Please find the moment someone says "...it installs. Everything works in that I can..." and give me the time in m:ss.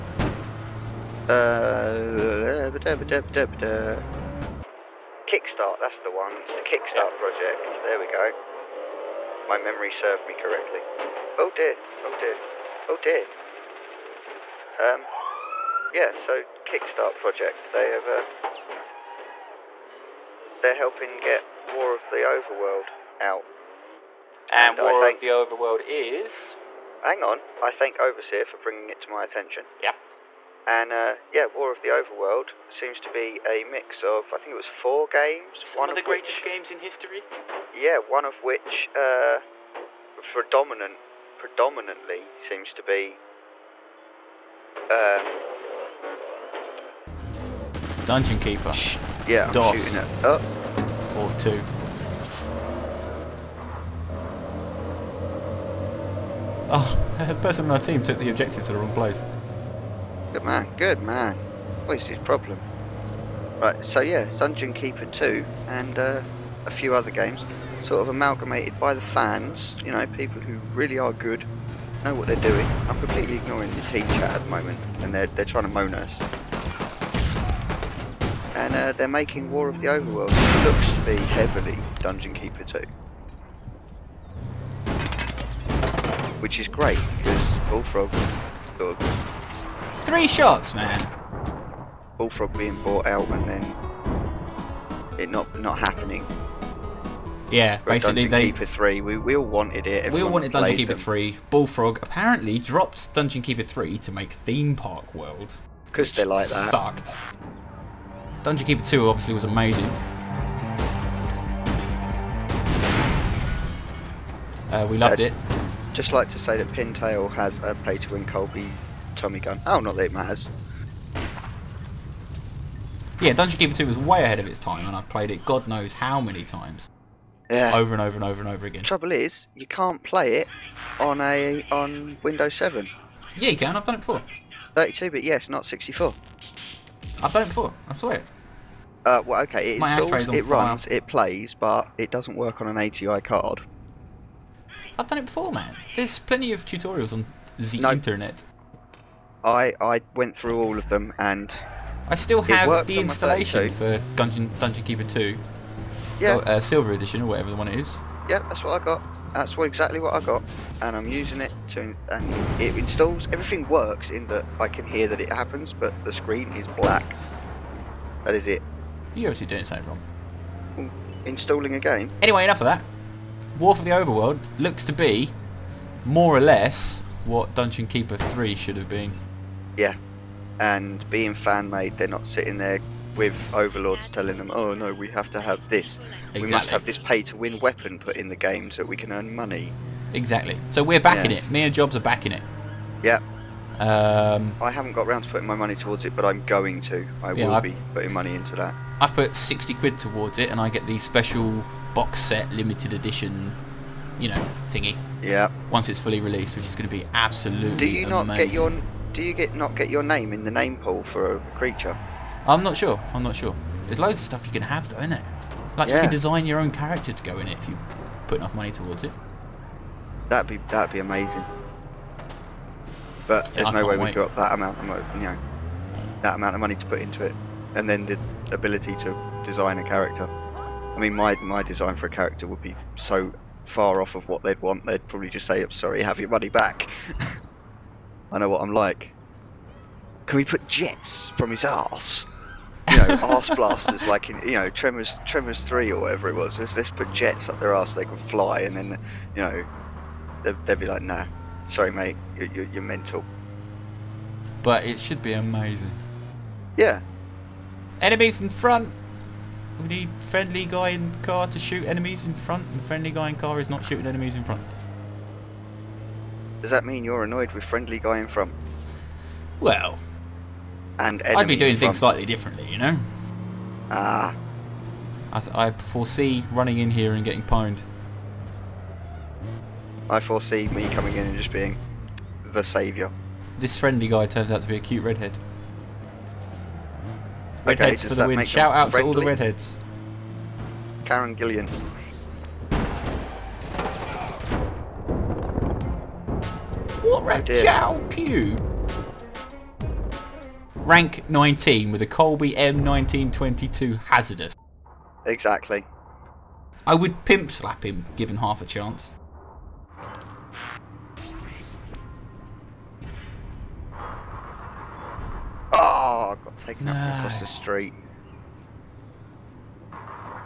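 2:42.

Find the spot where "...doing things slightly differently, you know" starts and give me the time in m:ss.
4:31.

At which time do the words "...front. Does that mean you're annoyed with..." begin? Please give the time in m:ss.
4:24.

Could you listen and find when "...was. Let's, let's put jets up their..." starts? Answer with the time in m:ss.
4:06.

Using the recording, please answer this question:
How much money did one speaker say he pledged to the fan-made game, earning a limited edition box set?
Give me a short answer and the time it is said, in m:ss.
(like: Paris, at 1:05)
60 quid, at 3:19.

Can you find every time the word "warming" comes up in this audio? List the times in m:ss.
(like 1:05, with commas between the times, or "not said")
not said.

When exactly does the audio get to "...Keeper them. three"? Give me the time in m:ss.
1:40.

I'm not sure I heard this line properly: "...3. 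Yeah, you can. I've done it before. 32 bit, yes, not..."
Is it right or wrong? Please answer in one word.
wrong.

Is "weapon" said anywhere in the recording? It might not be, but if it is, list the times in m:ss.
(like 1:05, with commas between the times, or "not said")
3:07.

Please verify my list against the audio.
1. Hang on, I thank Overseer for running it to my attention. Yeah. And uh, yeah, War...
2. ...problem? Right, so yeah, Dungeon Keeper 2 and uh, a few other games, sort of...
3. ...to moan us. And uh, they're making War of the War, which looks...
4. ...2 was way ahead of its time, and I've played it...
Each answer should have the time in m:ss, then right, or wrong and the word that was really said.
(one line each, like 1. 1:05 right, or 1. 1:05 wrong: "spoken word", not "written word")
1. 0:27 wrong: "bringing", not "running"
2. 1:02 right
3. 1:15 wrong: "Overworld", not "War"
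4. 2:03 right.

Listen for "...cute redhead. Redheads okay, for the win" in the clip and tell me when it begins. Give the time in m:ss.
4:44.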